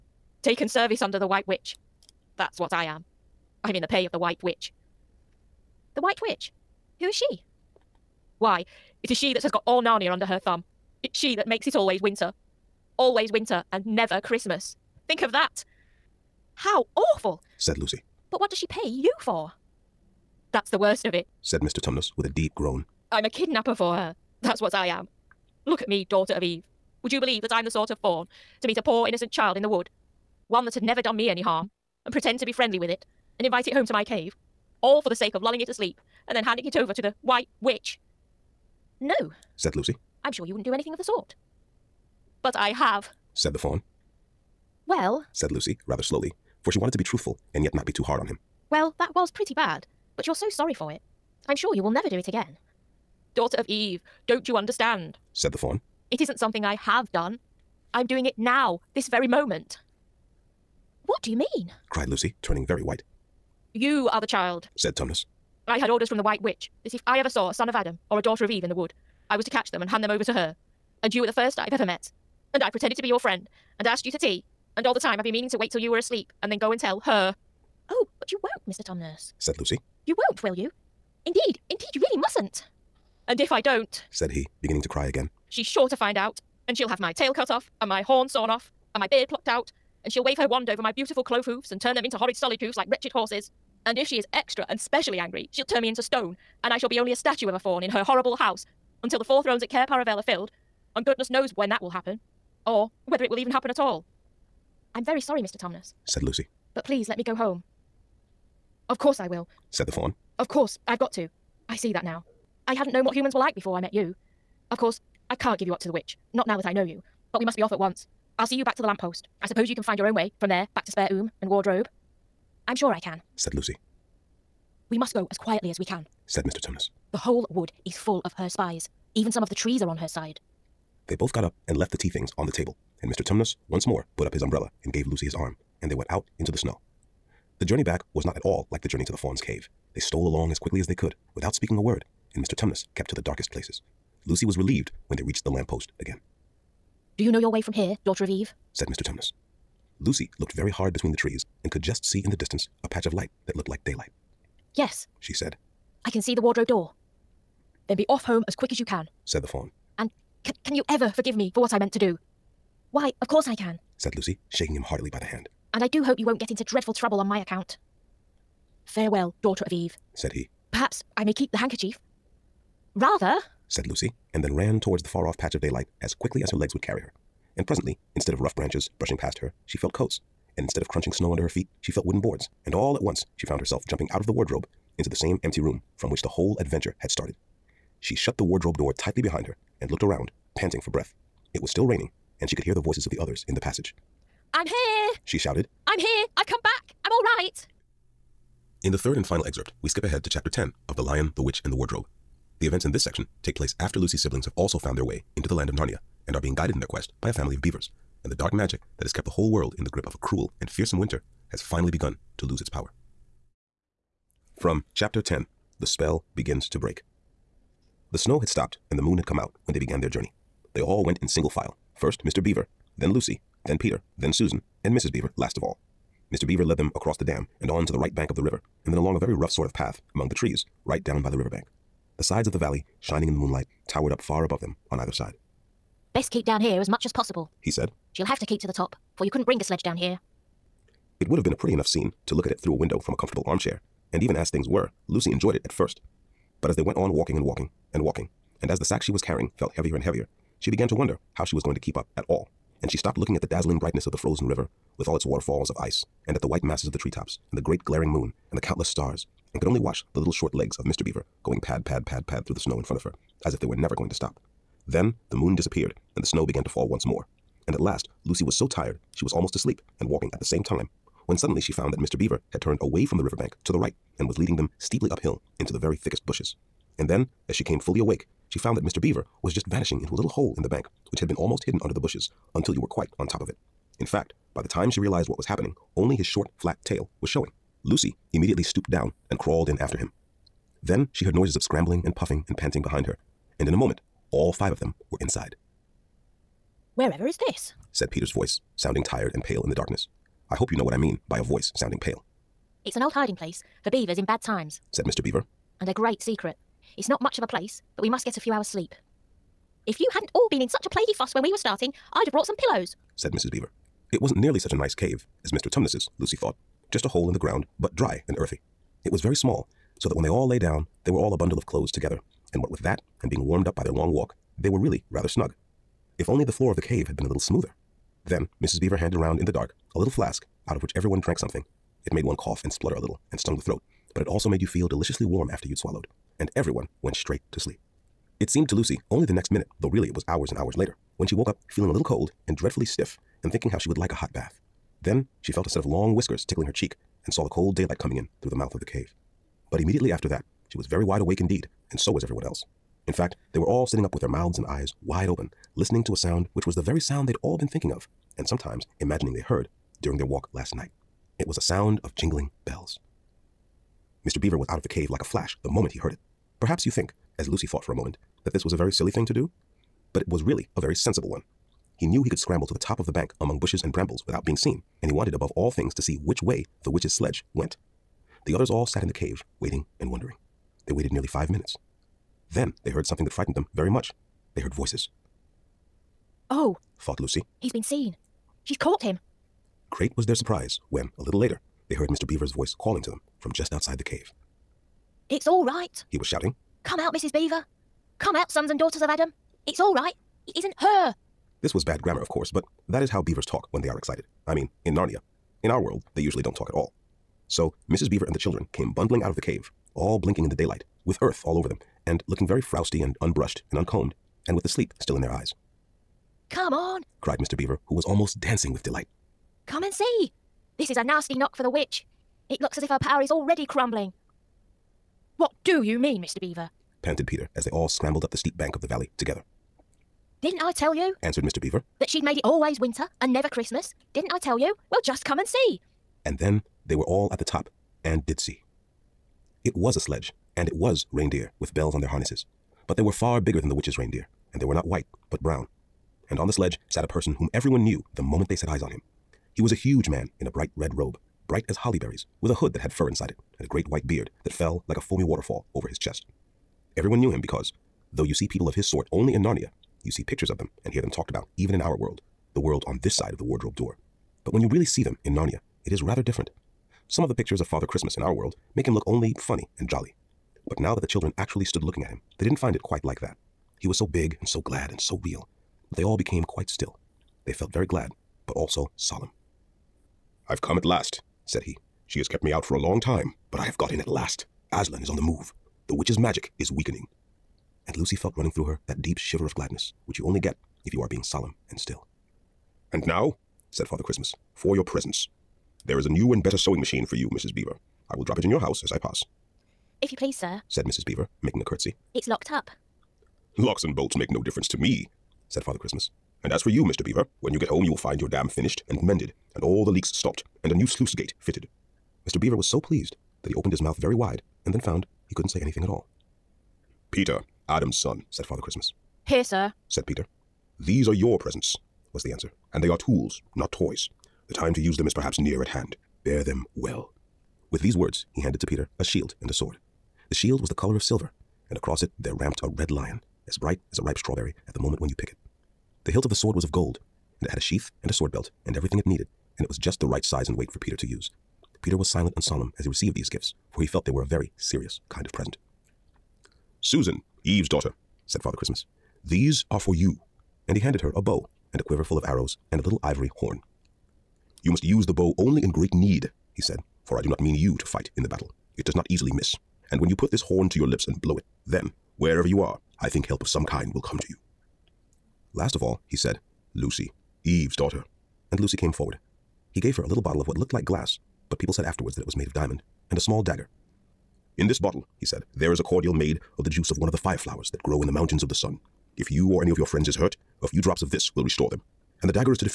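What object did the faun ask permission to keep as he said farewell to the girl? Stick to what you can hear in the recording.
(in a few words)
The handkerchief.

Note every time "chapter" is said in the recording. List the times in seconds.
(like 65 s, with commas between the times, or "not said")
200 s, 214 s.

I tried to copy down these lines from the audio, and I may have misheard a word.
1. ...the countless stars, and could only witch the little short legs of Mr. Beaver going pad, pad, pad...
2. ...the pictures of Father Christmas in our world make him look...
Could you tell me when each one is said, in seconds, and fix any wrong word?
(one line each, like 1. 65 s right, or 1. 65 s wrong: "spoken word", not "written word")
1. 258 s wrong: "watch", not "witch"
2. 467 s right.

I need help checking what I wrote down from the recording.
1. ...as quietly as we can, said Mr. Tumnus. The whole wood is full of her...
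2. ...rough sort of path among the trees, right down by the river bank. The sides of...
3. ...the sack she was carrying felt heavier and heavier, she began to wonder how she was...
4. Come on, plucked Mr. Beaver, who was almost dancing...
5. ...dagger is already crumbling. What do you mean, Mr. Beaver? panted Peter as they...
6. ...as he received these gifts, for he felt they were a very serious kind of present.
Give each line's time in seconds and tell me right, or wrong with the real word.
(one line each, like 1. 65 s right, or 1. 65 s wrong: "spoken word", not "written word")
1. 125 s right
2. 229 s right
3. 248 s right
4. 416 s wrong: "cried", not "plucked"
5. 422 s wrong: "power", not "dagger"
6. 542 s right.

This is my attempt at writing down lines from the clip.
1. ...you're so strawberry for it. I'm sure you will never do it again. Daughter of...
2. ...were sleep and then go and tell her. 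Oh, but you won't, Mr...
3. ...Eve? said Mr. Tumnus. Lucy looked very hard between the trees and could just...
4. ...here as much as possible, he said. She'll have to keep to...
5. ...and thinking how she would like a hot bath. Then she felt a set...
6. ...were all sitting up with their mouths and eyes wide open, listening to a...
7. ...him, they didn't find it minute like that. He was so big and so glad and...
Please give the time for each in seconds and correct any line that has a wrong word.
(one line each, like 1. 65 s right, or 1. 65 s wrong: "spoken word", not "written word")
1. 50 s wrong: "sorry", not "strawberry"
2. 75 s wrong: "asleep", not "sleep"
3. 148 s right
4. 236 s right
5. 343 s right
6. 353 s right
7. 472 s wrong: "quite", not "minute".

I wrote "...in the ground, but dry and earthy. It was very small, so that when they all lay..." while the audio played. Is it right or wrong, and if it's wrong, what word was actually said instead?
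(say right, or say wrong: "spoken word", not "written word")
right.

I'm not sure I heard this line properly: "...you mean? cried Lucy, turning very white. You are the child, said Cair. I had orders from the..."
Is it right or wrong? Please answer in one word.
wrong.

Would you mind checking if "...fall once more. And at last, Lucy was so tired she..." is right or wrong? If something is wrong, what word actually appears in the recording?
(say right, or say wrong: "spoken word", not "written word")
right.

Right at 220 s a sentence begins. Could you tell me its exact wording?
They all went in single file.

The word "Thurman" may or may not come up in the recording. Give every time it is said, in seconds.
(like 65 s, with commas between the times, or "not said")
not said.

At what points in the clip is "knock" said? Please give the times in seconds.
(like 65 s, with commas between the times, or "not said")
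421 s.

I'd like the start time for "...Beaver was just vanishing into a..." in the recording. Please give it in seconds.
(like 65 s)
279 s.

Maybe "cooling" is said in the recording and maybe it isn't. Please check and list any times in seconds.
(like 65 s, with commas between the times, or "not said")
not said.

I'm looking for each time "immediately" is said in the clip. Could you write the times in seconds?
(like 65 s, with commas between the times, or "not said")
288 s, 349 s.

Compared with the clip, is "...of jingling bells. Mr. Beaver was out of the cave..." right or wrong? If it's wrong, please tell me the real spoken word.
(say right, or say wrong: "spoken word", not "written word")
right.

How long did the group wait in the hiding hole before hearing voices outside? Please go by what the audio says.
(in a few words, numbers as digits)
Nearly five minutes.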